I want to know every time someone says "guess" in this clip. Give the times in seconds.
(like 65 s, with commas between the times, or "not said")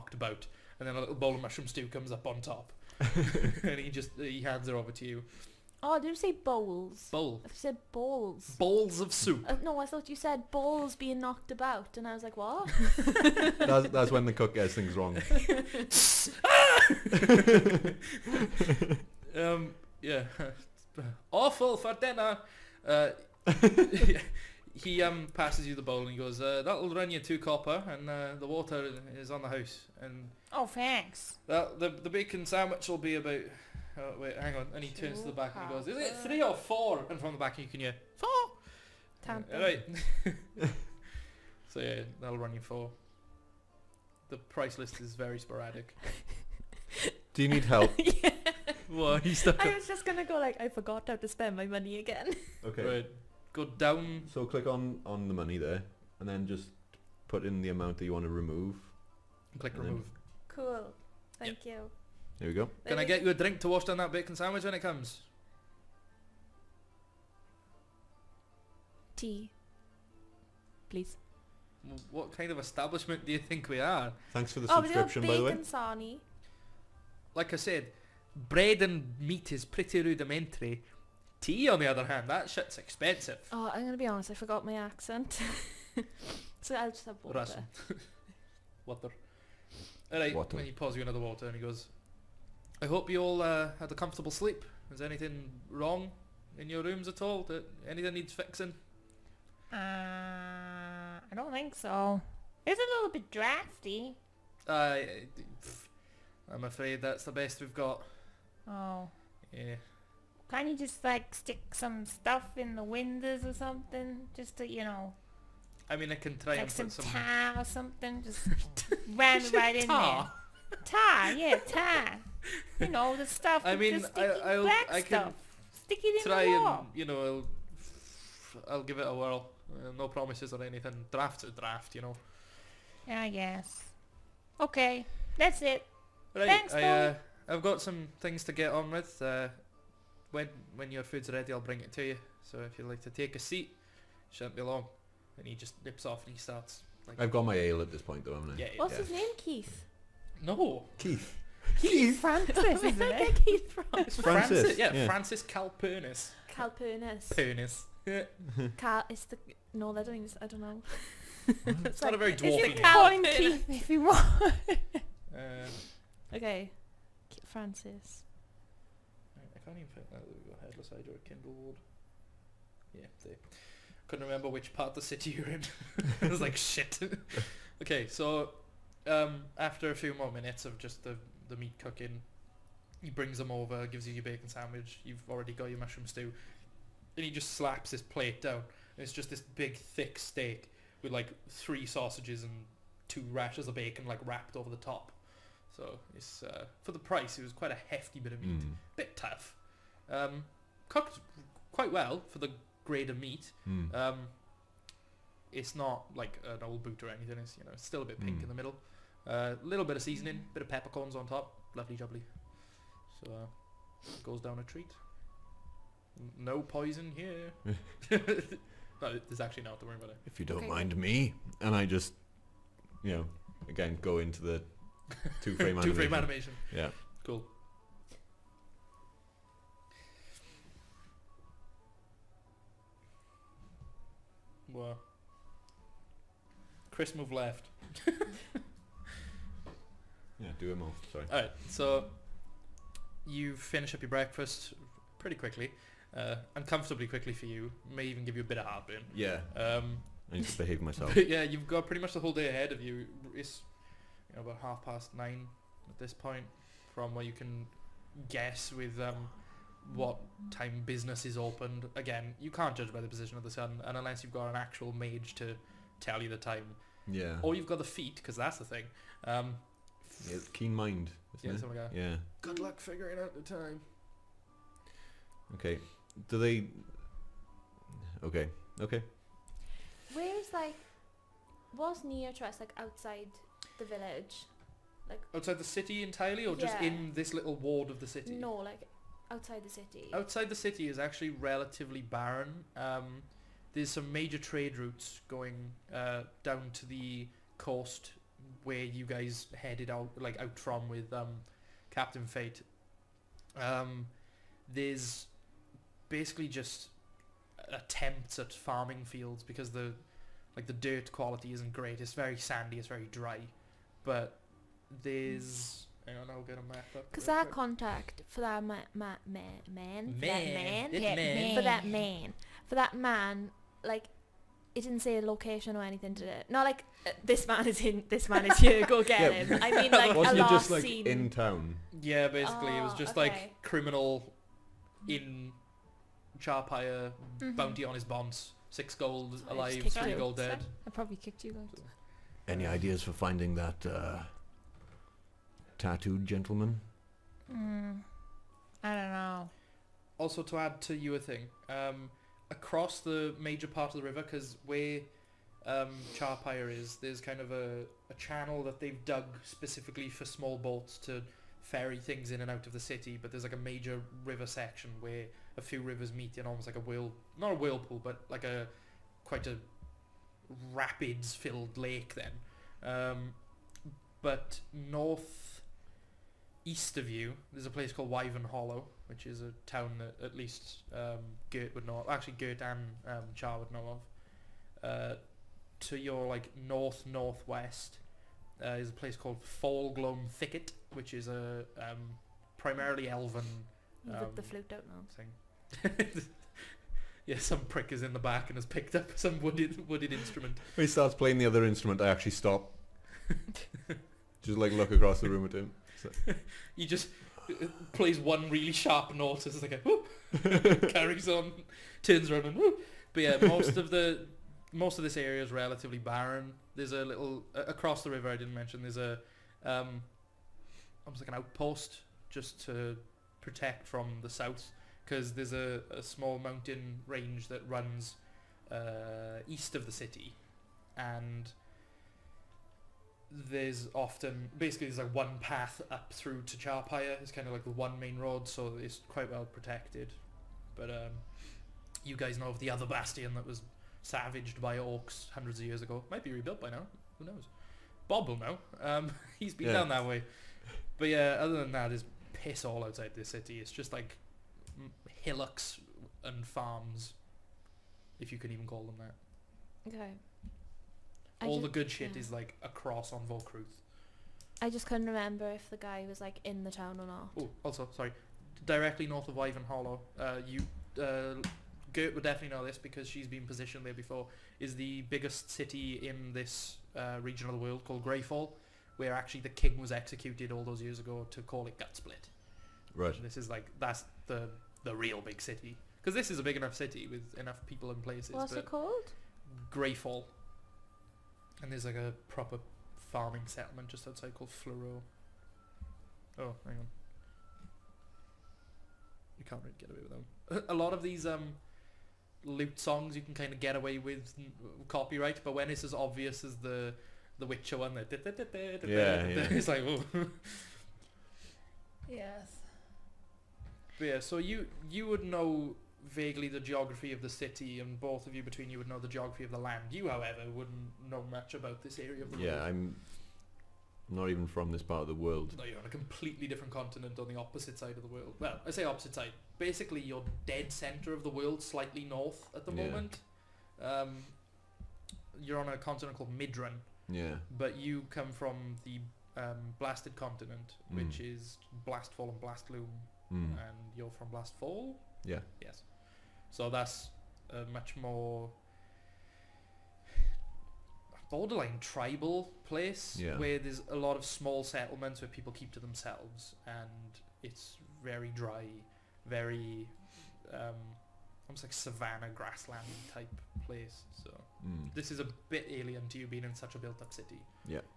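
133 s, 258 s.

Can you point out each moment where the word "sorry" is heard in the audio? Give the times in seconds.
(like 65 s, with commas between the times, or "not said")
241 s, 467 s.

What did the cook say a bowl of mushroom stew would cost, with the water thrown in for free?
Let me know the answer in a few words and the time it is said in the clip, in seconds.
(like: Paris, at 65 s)
2 copper, at 27 s.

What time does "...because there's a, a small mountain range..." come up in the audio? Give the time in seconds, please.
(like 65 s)
425 s.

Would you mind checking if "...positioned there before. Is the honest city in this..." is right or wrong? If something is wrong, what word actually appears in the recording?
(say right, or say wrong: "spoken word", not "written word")
wrong: "biggest", not "honest".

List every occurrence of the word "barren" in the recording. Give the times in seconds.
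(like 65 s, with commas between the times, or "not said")
292 s, 415 s.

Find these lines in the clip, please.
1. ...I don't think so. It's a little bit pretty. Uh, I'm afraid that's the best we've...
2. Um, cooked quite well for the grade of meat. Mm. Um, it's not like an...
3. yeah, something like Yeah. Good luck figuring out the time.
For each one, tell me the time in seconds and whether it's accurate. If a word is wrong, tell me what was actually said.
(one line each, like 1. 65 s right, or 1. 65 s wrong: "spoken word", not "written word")
1. 99 s wrong: "drafty", not "pretty"
2. 200 s right
3. 271 s right.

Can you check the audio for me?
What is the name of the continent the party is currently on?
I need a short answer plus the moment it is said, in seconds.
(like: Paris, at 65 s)
Midran, at 536 s.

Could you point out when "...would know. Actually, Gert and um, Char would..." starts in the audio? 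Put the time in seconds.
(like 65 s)
381 s.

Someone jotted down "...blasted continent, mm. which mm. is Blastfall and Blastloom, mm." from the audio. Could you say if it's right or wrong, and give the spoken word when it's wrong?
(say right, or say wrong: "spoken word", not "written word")
right.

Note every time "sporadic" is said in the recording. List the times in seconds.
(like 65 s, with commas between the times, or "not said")
45 s.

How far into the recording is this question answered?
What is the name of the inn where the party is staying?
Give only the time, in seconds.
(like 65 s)
170 s.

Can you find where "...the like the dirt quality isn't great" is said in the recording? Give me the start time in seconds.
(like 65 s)
309 s.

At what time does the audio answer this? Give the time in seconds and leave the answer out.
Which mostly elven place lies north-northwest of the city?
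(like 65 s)
389 s.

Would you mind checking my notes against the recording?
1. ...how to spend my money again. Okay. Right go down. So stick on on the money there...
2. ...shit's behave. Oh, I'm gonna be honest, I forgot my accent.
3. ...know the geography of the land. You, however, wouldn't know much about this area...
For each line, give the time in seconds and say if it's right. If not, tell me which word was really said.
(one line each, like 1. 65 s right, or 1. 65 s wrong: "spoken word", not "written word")
1. 51 s wrong: "click", not "stick"
2. 82 s wrong: "expensive", not "behave"
3. 518 s right.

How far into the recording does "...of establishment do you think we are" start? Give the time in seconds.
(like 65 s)
72 s.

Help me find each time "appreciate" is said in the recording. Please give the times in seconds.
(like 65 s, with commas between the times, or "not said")
not said.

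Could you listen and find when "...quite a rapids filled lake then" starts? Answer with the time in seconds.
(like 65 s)
369 s.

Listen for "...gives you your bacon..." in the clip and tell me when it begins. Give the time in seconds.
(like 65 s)
183 s.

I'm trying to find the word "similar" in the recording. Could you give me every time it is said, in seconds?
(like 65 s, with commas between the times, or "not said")
not said.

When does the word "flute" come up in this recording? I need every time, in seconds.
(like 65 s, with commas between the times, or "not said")
394 s.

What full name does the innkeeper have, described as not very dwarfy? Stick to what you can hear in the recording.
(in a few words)
Francis Calpurnis.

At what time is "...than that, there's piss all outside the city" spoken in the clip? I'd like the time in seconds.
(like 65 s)
451 s.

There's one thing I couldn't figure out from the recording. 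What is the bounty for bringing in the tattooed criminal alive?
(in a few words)
6 gold.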